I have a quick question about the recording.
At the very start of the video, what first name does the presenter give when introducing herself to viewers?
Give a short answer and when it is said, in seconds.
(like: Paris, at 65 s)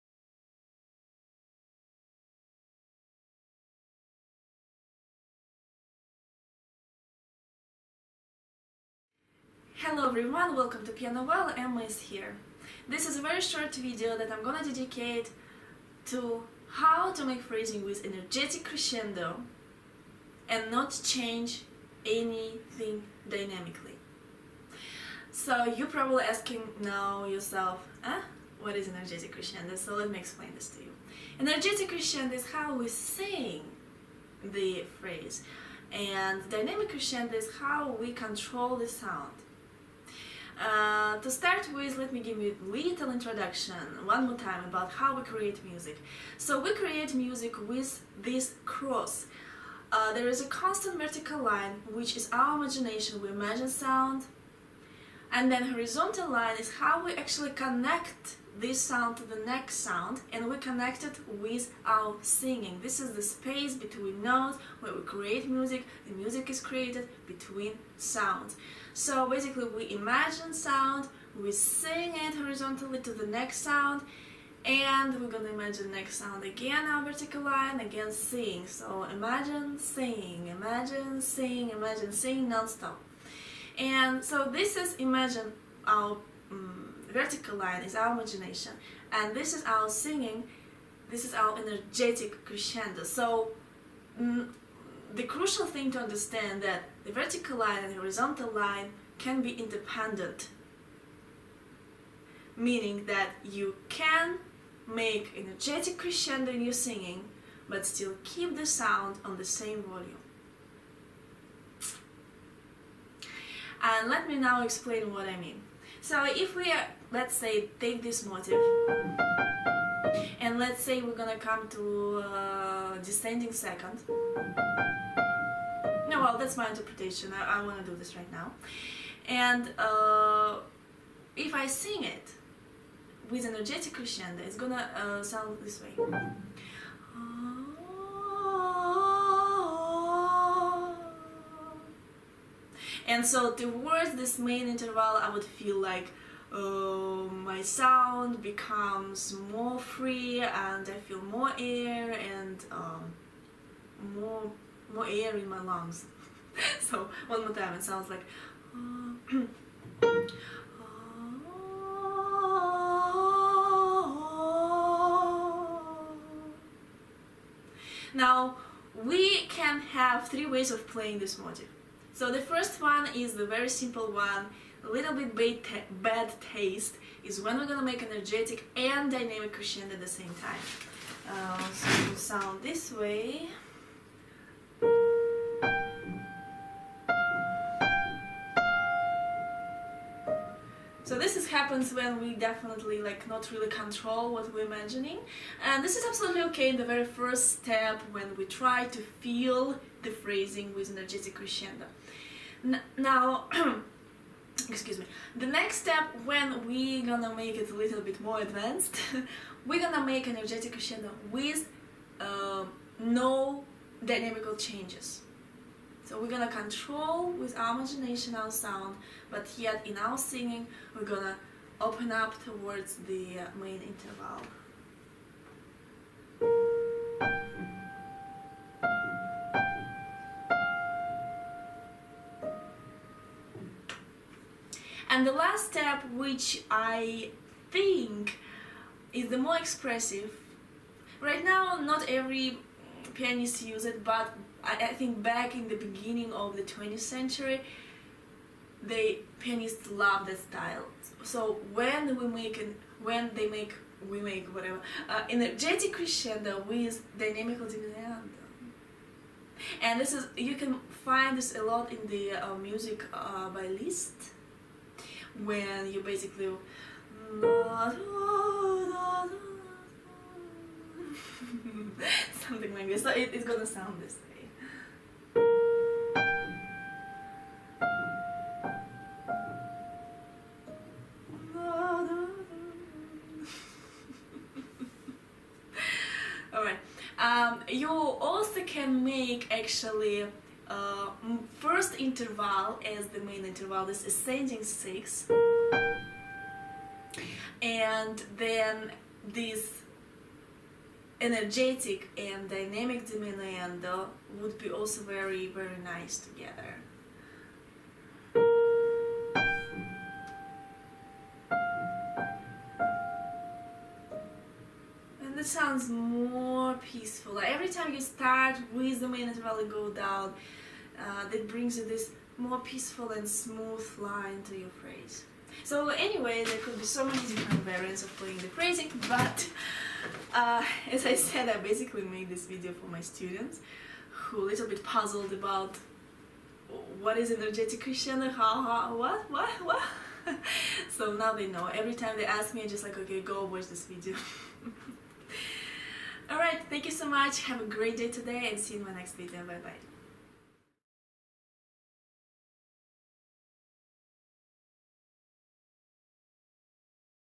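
Emma, at 11 s.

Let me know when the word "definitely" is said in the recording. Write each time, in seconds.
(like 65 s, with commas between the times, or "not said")
192 s.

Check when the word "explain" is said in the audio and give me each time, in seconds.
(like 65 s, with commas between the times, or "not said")
30 s, 114 s.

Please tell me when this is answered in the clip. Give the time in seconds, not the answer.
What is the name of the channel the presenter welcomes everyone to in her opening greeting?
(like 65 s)
10 s.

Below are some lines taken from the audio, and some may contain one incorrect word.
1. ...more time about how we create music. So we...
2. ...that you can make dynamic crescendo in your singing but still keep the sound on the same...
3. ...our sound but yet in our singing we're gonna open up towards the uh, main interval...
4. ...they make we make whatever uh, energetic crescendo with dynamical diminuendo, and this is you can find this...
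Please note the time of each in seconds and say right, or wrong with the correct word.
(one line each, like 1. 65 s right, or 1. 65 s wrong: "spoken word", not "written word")
1. 44 s right
2. 103 s wrong: "energetic", not "dynamic"
3. 218 s right
4. 253 s right.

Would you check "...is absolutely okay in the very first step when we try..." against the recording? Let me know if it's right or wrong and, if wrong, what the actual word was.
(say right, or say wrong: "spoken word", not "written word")
right.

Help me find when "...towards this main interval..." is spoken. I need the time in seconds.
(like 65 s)
143 s.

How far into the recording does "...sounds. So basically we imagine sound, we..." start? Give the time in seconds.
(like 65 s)
67 s.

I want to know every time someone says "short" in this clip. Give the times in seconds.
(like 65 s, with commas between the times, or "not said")
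13 s.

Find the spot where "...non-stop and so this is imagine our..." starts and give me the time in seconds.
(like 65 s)
82 s.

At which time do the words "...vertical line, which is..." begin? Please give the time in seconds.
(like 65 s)
50 s.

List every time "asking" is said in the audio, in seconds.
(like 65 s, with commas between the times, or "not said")
26 s.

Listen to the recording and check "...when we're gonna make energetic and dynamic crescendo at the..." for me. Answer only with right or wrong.
right.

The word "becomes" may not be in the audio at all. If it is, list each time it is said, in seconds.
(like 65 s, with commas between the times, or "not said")
148 s.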